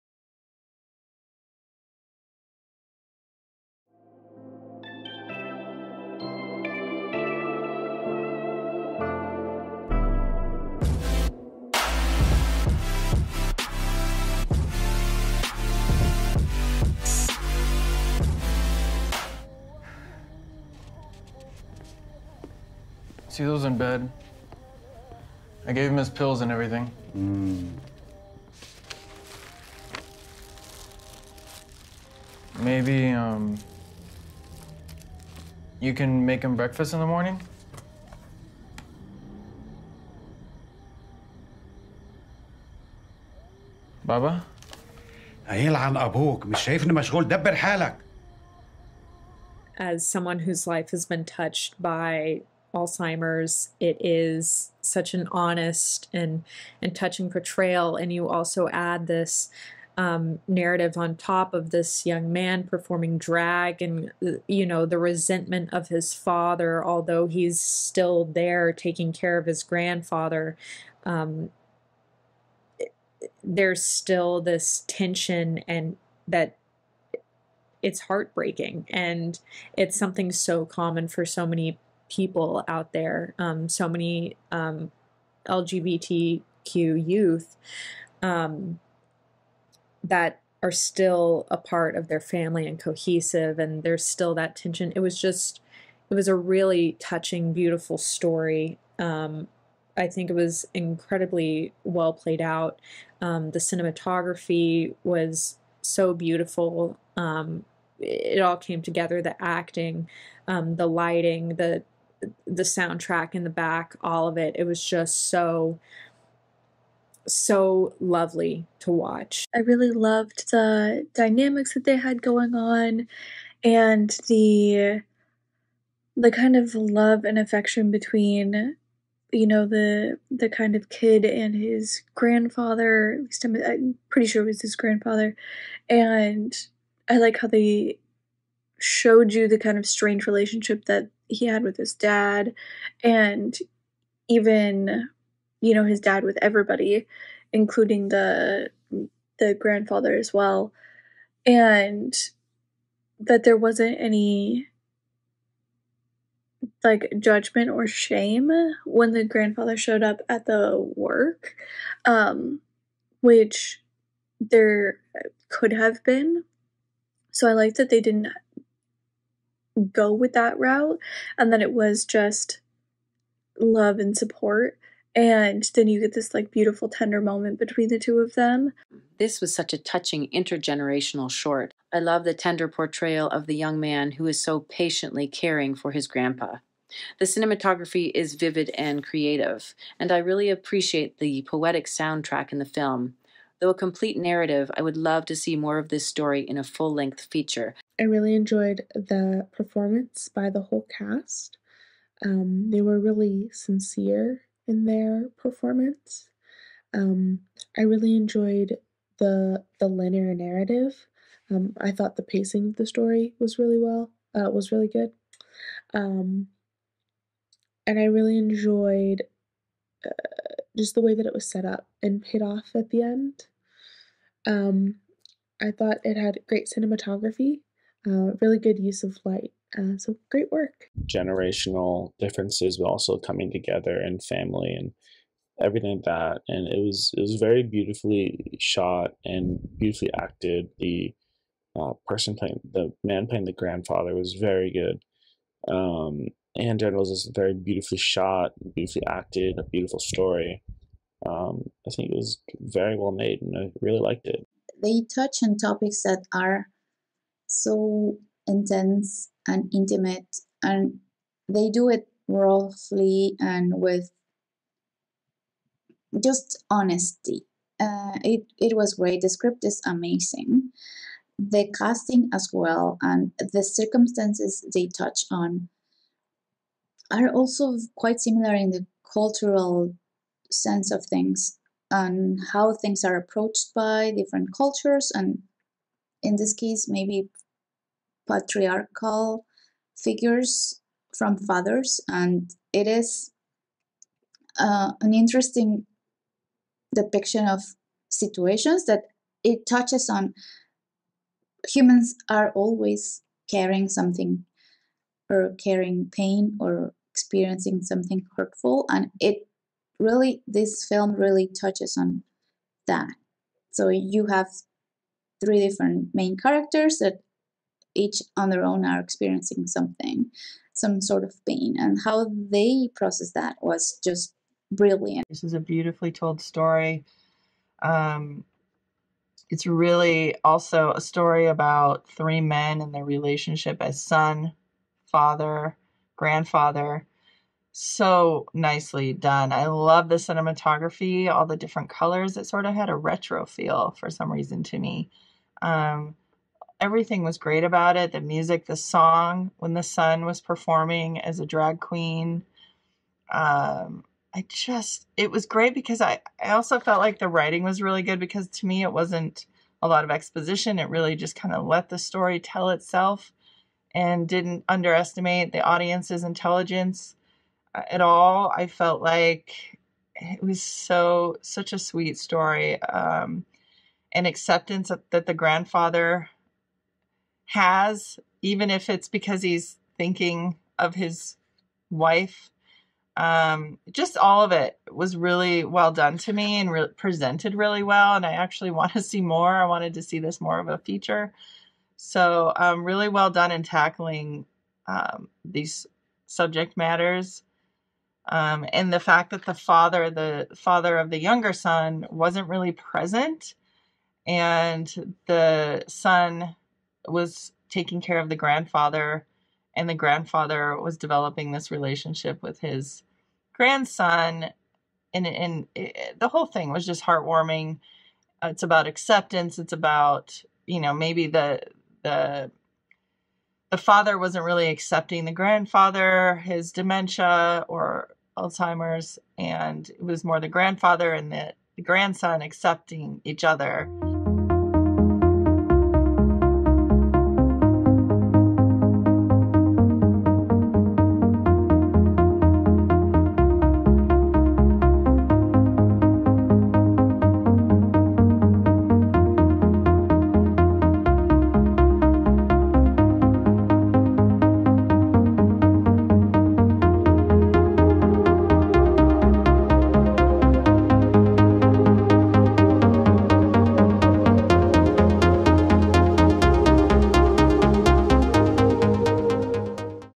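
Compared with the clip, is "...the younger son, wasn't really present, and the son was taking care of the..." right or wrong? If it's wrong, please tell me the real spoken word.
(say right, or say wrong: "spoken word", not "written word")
right.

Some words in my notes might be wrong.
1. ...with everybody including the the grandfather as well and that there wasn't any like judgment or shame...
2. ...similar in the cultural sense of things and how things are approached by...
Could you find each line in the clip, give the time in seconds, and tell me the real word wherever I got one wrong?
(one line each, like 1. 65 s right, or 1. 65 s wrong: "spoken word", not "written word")
1. 146 s right
2. 278 s right.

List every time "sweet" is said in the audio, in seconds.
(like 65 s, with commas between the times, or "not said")
371 s.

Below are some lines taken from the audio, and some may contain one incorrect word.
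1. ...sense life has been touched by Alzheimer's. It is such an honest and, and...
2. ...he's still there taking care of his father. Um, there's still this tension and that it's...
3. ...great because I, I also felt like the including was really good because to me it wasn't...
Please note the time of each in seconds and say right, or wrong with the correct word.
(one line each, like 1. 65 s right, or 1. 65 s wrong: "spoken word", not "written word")
1. 50 s wrong: "whose", not "sense"
2. 67 s wrong: "grandfather", not "father"
3. 355 s wrong: "writing", not "including".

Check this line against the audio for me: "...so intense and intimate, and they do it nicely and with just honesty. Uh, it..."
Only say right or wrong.
wrong.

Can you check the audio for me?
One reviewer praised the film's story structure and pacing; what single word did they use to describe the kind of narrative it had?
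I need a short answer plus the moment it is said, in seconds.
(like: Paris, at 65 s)
linear, at 209 s.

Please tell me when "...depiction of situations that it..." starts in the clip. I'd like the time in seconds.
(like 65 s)
296 s.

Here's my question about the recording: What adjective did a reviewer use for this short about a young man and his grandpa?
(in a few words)
intergenerational.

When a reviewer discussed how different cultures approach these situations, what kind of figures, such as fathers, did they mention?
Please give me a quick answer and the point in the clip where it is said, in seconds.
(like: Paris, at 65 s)
patriarchal figures, at 288 s.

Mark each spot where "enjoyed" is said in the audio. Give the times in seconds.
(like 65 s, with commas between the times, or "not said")
198 s, 208 s, 218 s.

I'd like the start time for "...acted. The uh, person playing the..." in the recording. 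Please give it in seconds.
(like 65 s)
240 s.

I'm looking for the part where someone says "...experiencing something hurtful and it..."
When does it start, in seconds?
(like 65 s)
307 s.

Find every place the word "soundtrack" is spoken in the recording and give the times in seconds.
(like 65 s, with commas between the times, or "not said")
112 s, 191 s.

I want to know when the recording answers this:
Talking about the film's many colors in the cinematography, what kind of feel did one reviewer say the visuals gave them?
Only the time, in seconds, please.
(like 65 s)
342 s.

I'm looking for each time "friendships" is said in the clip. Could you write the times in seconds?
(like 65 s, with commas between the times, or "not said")
not said.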